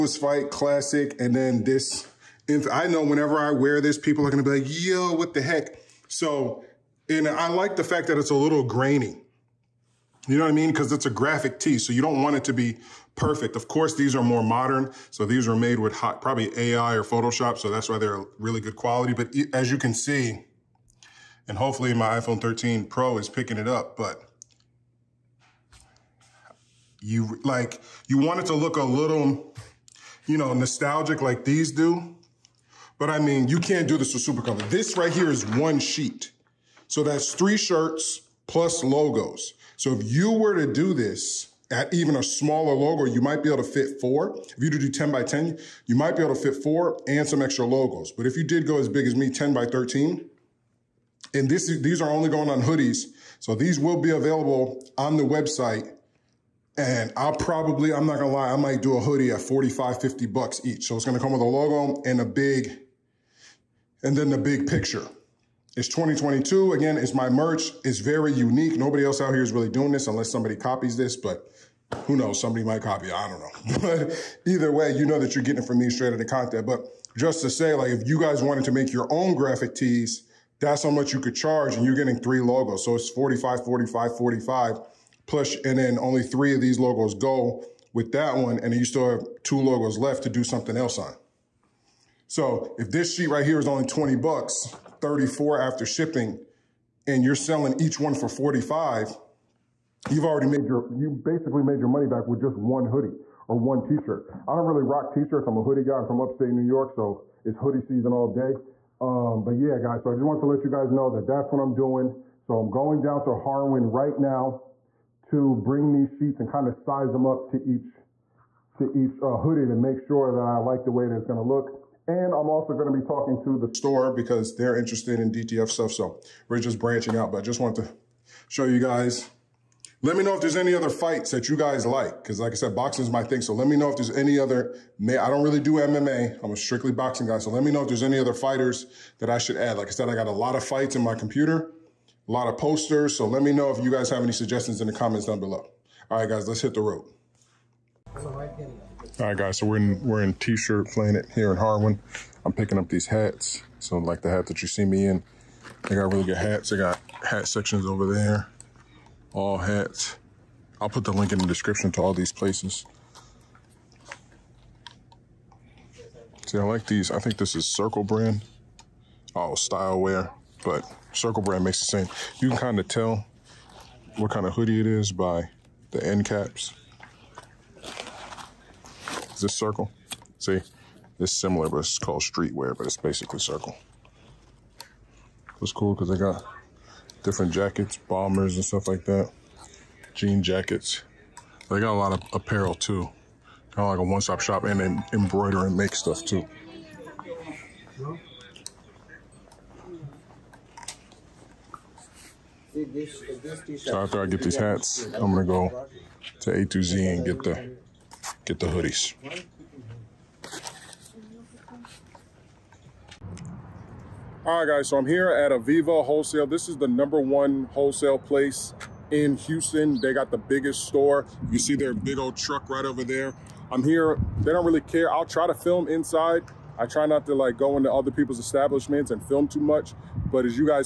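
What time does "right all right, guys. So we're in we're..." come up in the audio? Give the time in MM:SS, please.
02:28.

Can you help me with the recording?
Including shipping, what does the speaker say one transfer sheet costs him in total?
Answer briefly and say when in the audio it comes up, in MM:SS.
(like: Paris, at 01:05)
$34, at 01:35.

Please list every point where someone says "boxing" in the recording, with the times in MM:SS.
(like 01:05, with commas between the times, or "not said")
02:12, 02:16.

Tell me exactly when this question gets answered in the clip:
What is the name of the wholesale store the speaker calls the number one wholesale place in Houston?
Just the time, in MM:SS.
03:35.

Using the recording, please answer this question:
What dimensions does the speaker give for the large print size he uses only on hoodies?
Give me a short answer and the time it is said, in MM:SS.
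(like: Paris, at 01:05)
10 by 13, at 00:49.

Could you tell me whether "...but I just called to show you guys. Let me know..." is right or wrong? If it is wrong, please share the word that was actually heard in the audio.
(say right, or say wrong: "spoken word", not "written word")
wrong: "wanted", not "called".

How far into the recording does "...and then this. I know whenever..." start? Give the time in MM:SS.
00:01.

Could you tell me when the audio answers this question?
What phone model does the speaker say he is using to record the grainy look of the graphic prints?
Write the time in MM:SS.
00:22.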